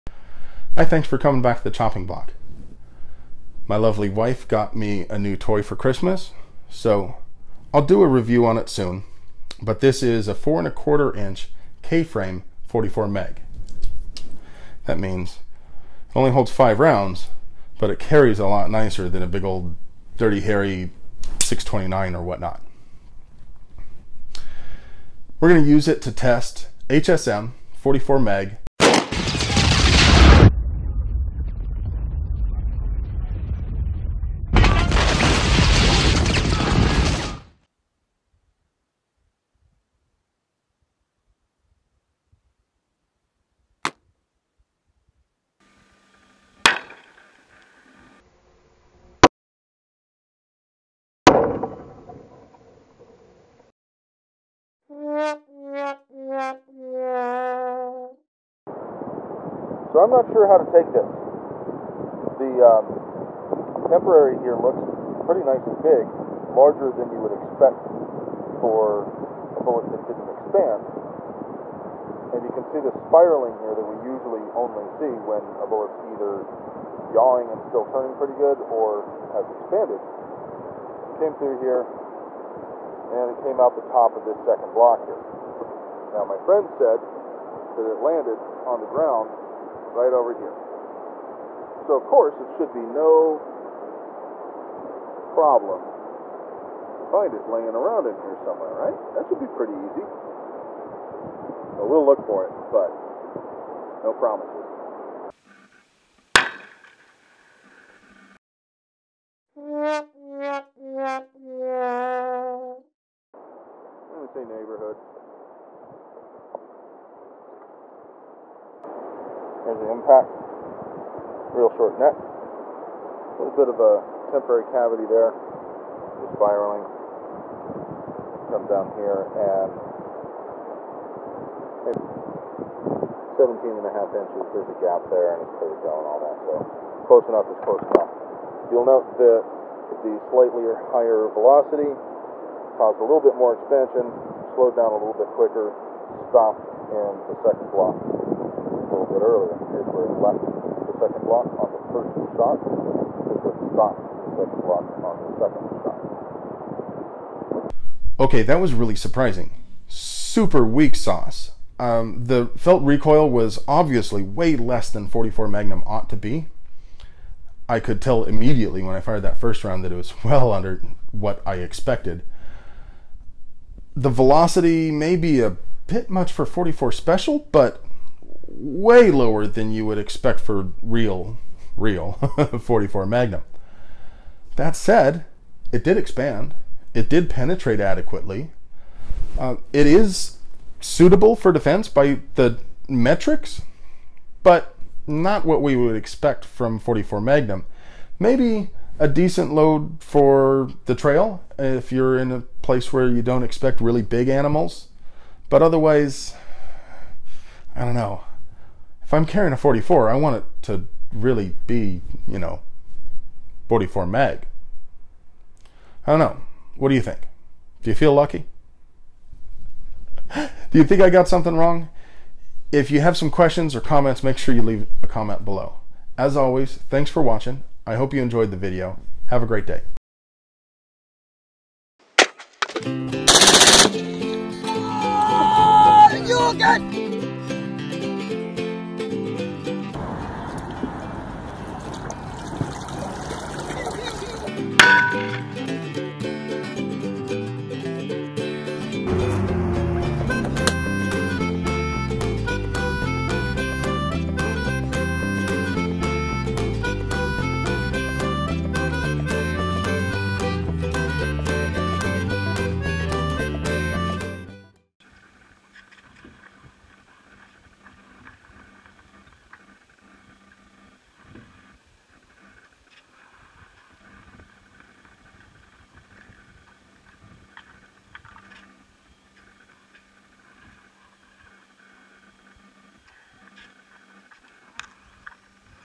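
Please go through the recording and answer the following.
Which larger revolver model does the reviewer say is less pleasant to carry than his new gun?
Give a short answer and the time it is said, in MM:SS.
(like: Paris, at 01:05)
629, at 00:21.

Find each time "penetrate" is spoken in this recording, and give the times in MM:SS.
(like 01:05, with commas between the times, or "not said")
03:07.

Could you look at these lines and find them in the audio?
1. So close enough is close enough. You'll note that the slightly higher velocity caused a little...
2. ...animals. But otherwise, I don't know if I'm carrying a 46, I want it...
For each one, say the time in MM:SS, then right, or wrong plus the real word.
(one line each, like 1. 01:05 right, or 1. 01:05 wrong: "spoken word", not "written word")
1. 02:16 right
2. 03:24 wrong: "44", not "46".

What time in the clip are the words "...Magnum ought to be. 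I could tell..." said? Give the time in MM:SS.
02:45.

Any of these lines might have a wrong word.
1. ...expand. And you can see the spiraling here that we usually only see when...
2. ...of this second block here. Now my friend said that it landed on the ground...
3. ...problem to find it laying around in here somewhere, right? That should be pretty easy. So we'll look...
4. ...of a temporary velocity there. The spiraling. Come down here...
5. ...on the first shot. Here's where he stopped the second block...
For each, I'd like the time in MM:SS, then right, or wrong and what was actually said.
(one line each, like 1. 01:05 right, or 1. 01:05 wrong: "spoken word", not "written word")
1. 01:10 right
2. 01:24 right
3. 01:35 right
4. 02:03 wrong: "cavity", not "velocity"
5. 02:31 right.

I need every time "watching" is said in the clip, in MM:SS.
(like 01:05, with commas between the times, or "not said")
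03:47.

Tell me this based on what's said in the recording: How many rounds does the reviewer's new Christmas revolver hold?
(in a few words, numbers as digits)
5.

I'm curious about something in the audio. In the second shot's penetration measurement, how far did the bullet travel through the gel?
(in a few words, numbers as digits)
17.5 inches.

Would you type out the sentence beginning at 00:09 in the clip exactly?
But this is a four and a quarter inch K-frame 44 mag.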